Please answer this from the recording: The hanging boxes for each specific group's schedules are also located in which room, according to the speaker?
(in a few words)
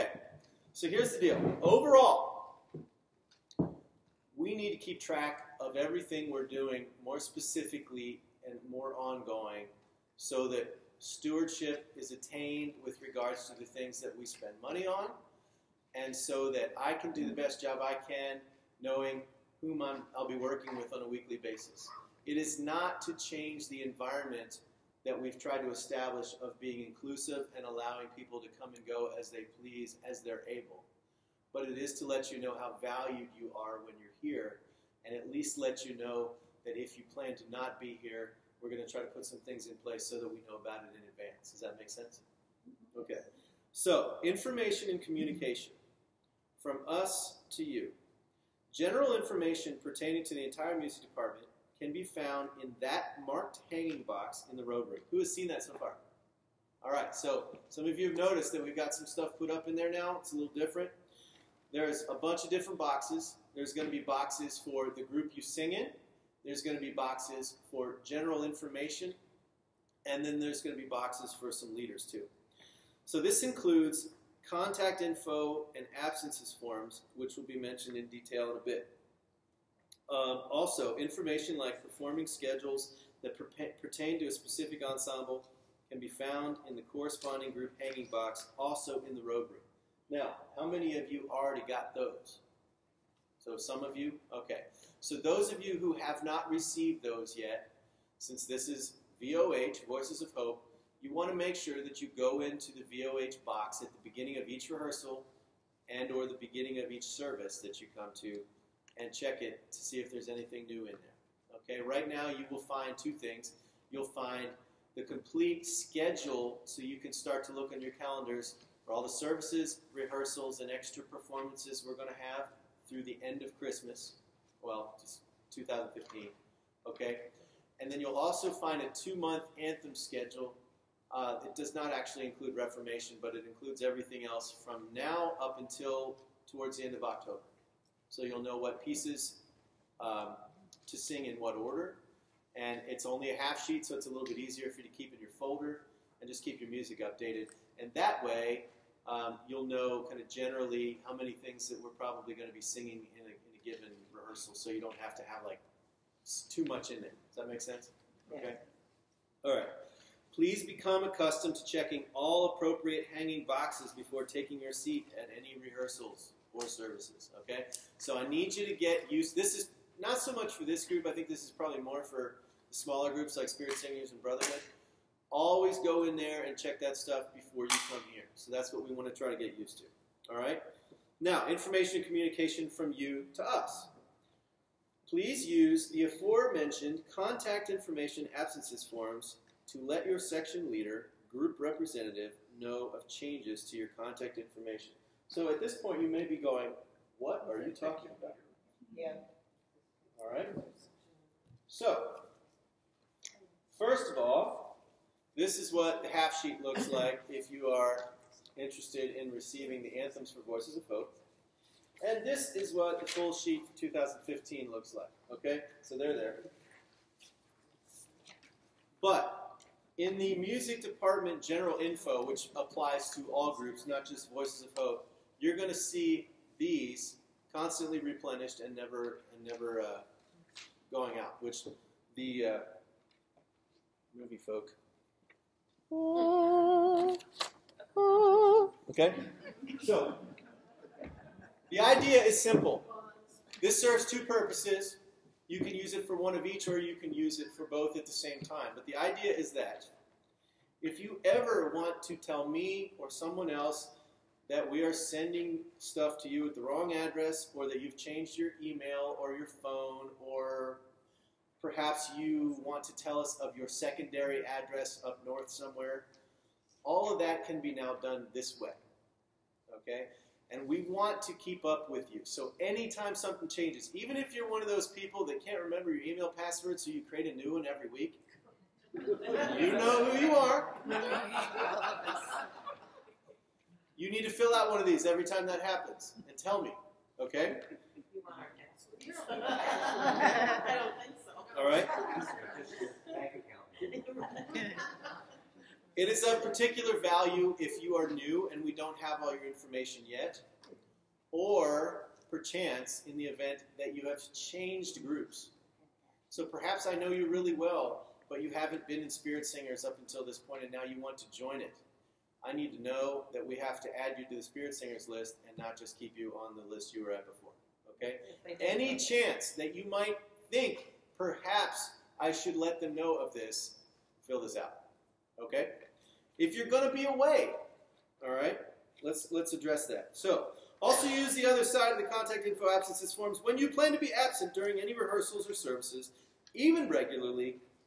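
robe room.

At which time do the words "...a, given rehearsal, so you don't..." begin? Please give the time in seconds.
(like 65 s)
153 s.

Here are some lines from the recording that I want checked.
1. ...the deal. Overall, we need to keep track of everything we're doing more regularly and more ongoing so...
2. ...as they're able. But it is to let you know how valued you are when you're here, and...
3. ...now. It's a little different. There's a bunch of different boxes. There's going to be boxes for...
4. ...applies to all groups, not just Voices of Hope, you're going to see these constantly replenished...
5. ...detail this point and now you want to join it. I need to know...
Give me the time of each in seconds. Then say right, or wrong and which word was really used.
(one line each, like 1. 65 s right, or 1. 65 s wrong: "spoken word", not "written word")
1. 1 s wrong: "specifically", not "regularly"
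2. 30 s right
3. 59 s right
4. 222 s right
5. 309 s wrong: "until", not "detail".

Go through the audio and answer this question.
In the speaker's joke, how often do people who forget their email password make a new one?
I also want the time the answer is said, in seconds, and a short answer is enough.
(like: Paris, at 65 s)
every week, at 277 s.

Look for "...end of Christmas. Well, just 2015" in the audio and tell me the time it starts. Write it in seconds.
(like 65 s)
123 s.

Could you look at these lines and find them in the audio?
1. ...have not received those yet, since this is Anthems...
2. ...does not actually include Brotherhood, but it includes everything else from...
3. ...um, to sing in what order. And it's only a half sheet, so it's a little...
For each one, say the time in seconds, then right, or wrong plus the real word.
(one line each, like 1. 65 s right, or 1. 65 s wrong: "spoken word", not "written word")
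1. 95 s wrong: "VOH", not "Anthems"
2. 131 s wrong: "Reformation", not "Brotherhood"
3. 140 s right.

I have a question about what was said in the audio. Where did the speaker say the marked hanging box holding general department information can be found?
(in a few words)
the rotary.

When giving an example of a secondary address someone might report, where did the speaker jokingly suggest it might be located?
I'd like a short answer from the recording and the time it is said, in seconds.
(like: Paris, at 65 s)
up north, at 265 s.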